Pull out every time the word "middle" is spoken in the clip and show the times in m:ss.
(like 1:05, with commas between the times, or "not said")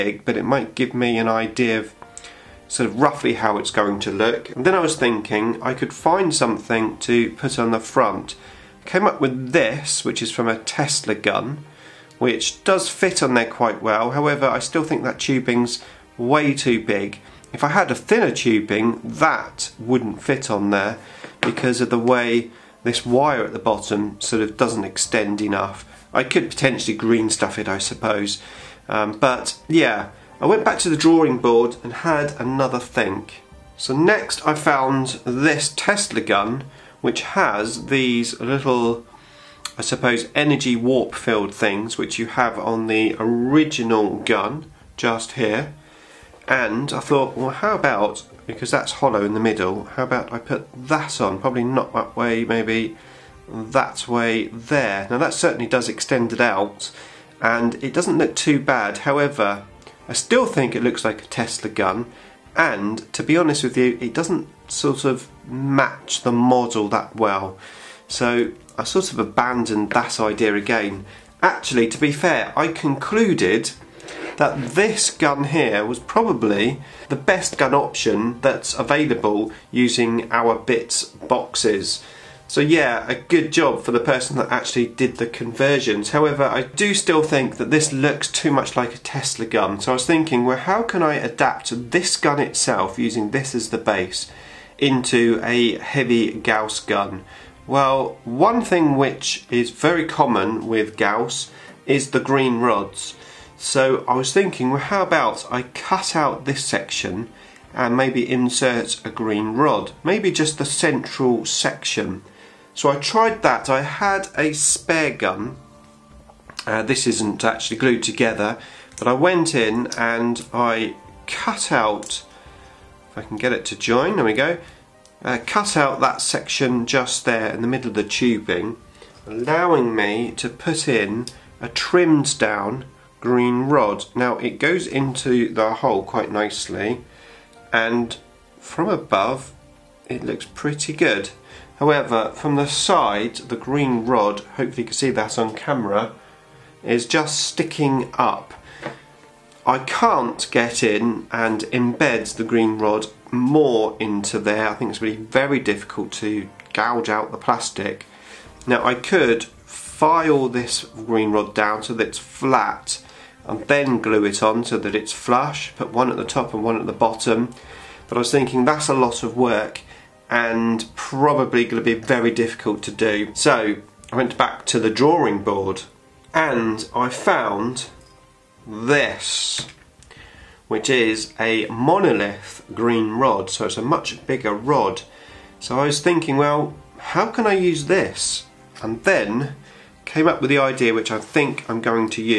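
0:49, 2:07.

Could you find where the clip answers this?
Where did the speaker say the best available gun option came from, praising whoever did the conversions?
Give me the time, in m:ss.
1:20.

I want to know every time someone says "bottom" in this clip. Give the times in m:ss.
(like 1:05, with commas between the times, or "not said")
0:23, 2:46.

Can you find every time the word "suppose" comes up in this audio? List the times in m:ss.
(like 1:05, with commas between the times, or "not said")
0:27, 0:39.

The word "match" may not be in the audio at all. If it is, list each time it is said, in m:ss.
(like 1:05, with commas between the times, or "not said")
1:05.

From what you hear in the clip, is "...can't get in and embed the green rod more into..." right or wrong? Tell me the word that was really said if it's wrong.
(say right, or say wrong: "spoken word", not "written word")
right.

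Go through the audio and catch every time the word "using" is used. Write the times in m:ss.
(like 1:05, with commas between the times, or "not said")
1:19, 1:32.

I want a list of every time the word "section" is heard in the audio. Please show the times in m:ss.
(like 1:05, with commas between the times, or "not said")
1:46, 1:51, 2:06.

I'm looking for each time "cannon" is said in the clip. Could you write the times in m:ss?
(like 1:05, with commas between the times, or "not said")
not said.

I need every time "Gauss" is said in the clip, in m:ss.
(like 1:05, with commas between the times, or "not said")
1:36, 1:40.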